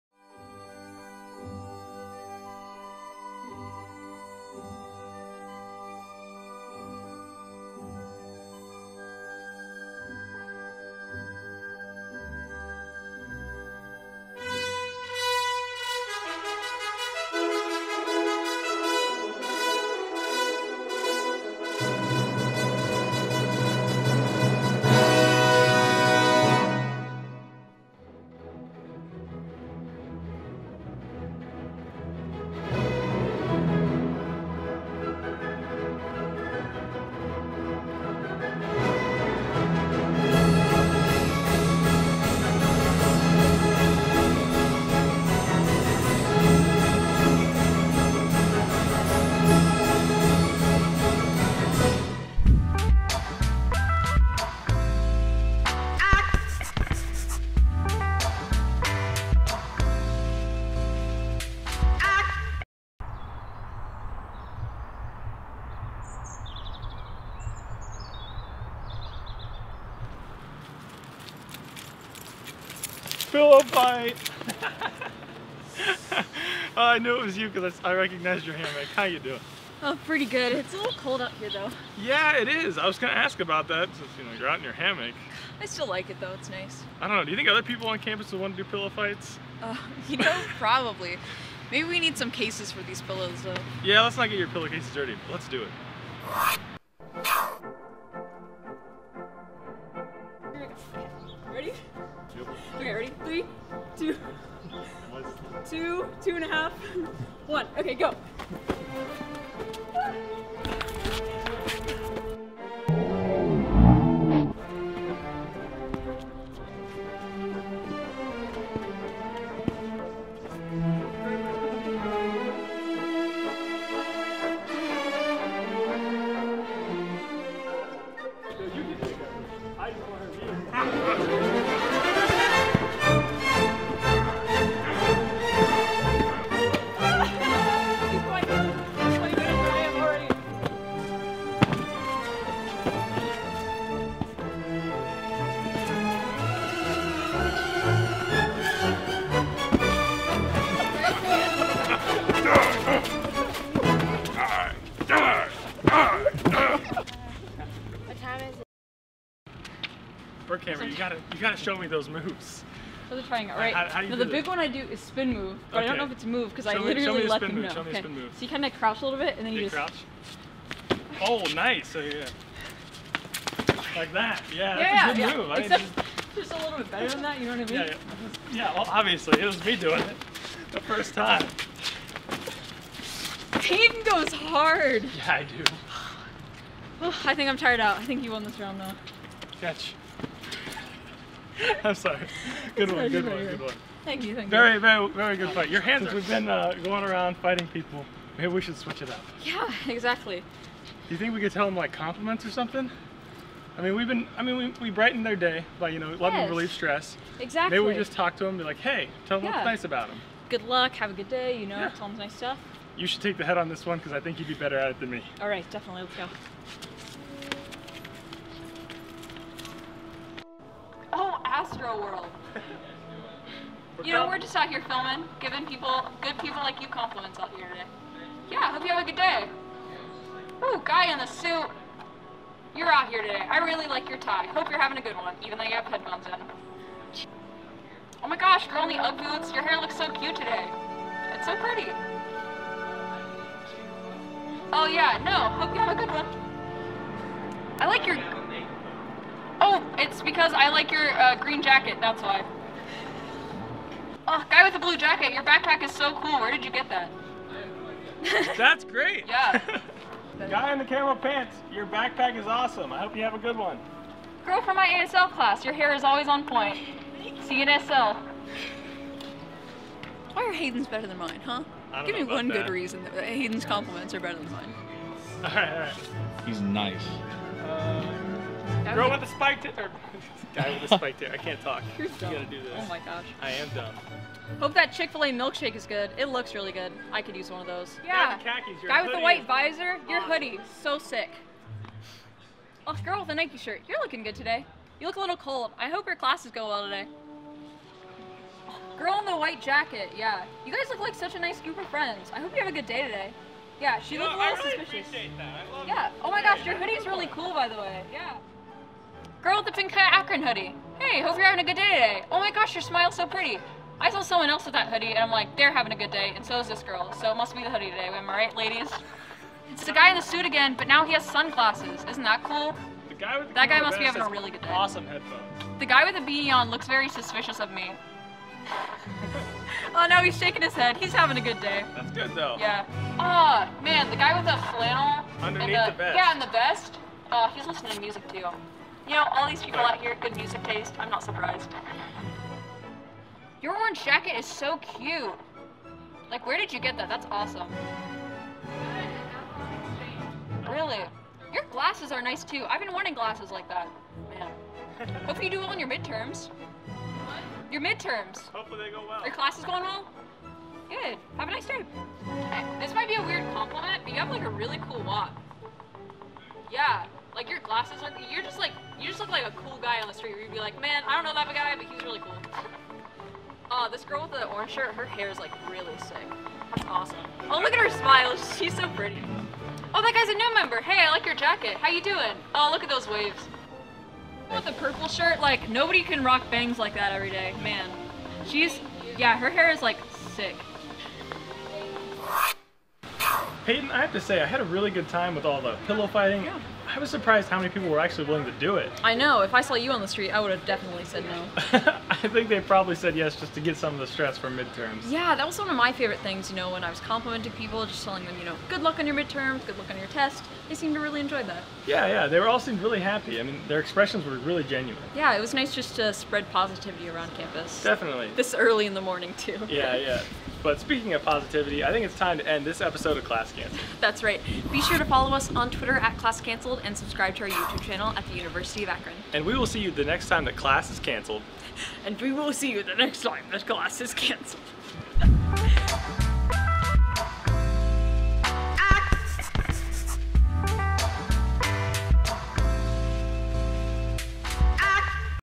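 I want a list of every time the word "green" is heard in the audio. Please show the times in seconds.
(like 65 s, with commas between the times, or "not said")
251 s.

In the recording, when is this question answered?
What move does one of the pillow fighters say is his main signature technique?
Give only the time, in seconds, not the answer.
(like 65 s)
165 s.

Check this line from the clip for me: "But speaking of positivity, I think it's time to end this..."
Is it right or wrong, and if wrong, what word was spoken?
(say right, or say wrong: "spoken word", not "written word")
right.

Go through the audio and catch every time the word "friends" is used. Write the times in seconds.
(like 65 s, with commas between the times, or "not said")
301 s.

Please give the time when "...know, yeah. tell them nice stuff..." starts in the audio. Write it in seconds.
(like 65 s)
211 s.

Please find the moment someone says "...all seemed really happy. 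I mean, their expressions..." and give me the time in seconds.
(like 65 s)
412 s.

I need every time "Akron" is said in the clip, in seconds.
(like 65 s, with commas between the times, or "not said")
309 s, 428 s.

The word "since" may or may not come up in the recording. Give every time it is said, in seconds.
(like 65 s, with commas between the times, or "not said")
83 s.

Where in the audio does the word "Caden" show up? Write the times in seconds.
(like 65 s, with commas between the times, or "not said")
183 s.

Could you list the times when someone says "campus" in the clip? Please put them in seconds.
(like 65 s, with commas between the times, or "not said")
87 s, 417 s.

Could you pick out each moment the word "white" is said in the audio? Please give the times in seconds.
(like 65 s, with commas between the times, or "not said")
289 s, 299 s.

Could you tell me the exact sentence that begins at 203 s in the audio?
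I mean, we've been, I mean, we, we their day by, you know, letting yes.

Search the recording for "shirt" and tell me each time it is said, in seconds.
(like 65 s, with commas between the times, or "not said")
293 s, 374 s, 385 s.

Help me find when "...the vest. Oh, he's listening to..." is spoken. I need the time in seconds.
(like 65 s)
336 s.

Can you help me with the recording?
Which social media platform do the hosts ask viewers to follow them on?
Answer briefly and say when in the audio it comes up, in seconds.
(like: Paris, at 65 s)
Twitter, at 425 s.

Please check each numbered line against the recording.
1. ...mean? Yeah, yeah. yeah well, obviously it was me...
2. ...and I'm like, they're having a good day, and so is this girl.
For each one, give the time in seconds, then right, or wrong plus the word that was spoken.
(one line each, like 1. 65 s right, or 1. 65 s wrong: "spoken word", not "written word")
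1. 177 s right
2. 315 s right.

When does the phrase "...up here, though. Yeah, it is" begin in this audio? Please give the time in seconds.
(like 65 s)
81 s.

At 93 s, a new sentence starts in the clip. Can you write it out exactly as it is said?
Yeah, let's not get your pillowcases dirty.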